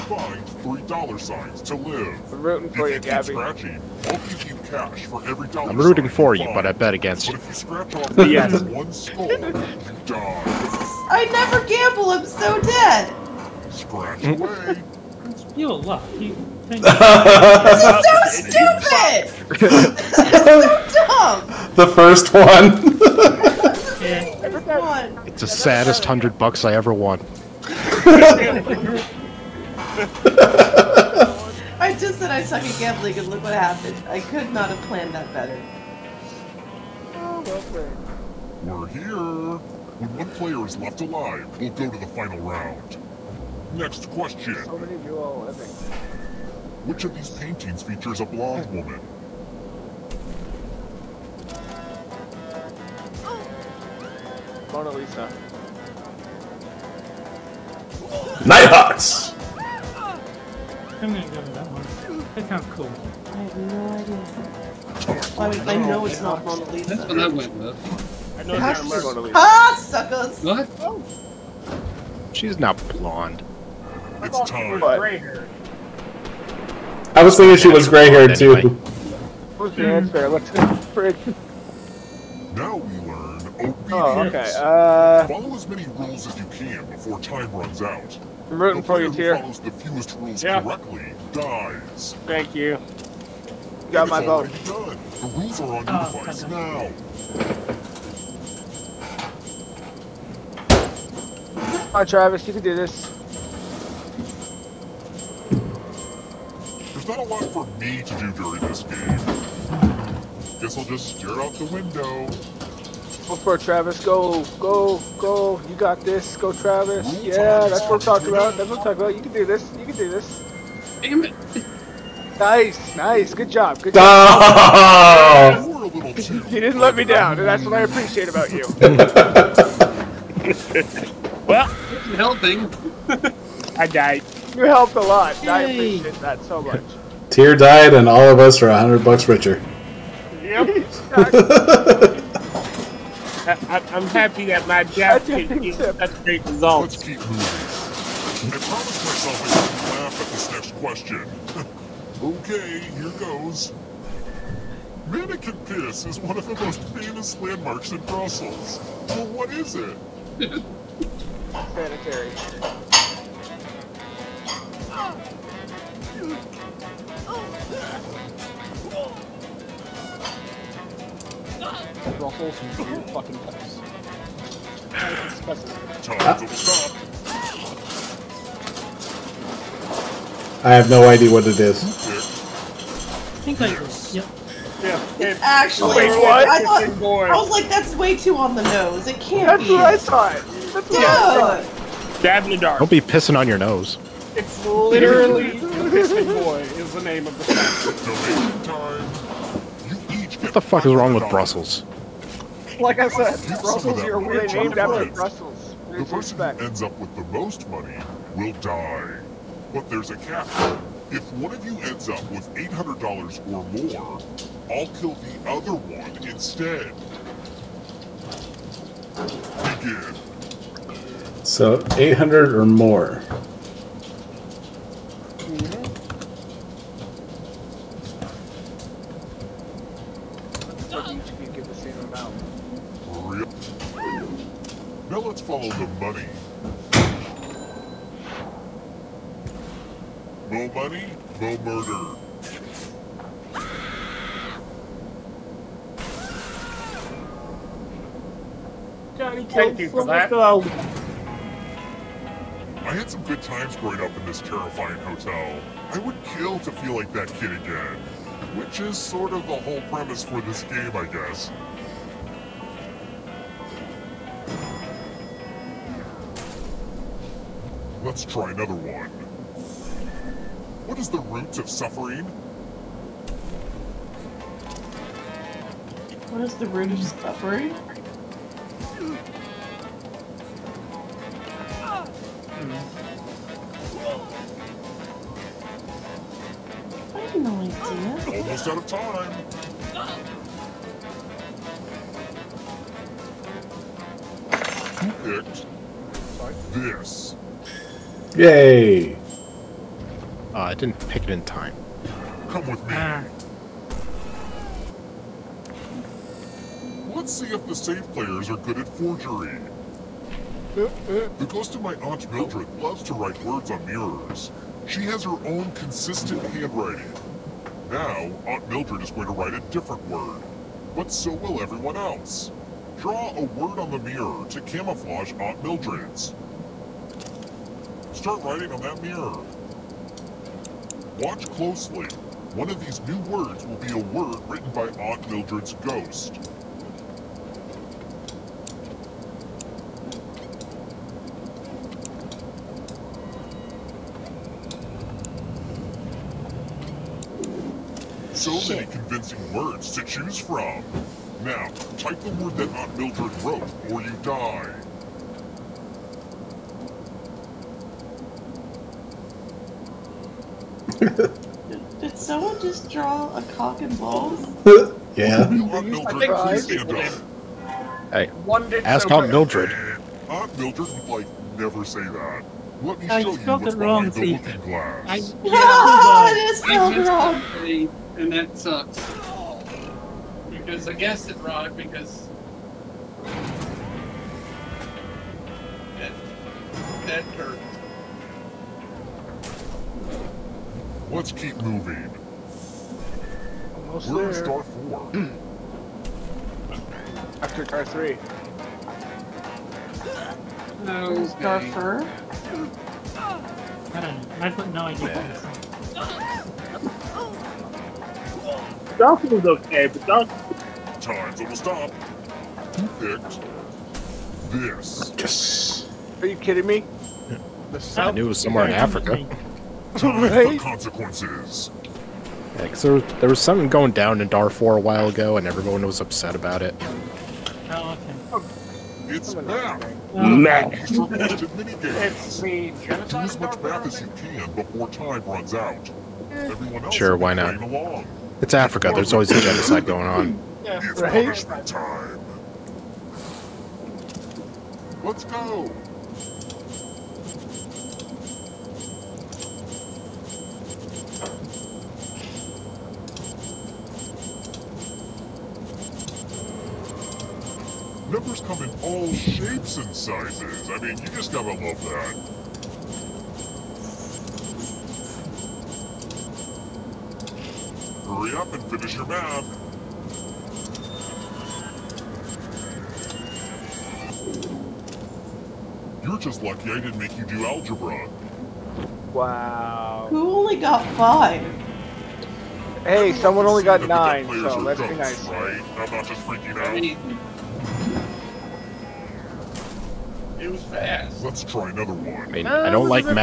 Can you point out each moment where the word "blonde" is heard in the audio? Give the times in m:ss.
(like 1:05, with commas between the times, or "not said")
0:48, 1:12.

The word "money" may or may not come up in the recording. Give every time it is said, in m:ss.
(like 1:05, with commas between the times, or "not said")
3:27, 3:56, 4:00.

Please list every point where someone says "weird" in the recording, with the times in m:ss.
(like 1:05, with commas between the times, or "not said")
3:24.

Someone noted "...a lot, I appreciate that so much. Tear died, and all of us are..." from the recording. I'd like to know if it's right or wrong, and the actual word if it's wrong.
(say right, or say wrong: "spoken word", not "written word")
right.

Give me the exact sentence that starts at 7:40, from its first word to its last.
I mean, you just gotta love that.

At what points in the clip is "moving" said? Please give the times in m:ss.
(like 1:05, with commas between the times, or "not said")
2:27, 6:31.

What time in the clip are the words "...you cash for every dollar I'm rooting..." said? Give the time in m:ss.
0:04.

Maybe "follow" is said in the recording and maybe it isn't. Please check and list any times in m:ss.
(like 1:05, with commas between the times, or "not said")
1:25, 1:29.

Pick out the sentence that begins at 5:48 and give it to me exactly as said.
So many convincing words to choose from.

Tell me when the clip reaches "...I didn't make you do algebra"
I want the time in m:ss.
7:56.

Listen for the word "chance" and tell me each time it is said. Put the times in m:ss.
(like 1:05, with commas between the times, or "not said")
not said.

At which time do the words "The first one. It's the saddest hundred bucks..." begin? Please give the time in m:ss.
0:21.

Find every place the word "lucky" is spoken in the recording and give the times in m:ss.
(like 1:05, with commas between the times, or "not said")
0:15, 7:56.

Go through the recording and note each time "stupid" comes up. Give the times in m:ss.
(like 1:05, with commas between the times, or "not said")
0:18.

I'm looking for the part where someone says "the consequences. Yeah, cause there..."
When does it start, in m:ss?
7:00.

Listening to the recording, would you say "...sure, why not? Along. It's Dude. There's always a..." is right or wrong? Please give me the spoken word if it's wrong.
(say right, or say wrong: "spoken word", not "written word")
wrong: "Africa", not "Dude".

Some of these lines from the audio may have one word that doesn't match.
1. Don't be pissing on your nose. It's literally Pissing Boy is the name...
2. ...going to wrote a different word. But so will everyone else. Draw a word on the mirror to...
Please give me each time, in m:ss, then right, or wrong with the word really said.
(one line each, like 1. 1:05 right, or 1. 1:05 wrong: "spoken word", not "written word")
1. 3:12 right
2. 5:19 wrong: "write", not "wrote".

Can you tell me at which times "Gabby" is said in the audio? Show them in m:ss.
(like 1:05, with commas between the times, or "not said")
0:03.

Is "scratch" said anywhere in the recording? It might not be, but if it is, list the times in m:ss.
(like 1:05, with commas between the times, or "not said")
0:07, 0:13.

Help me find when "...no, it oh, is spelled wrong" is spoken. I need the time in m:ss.
6:15.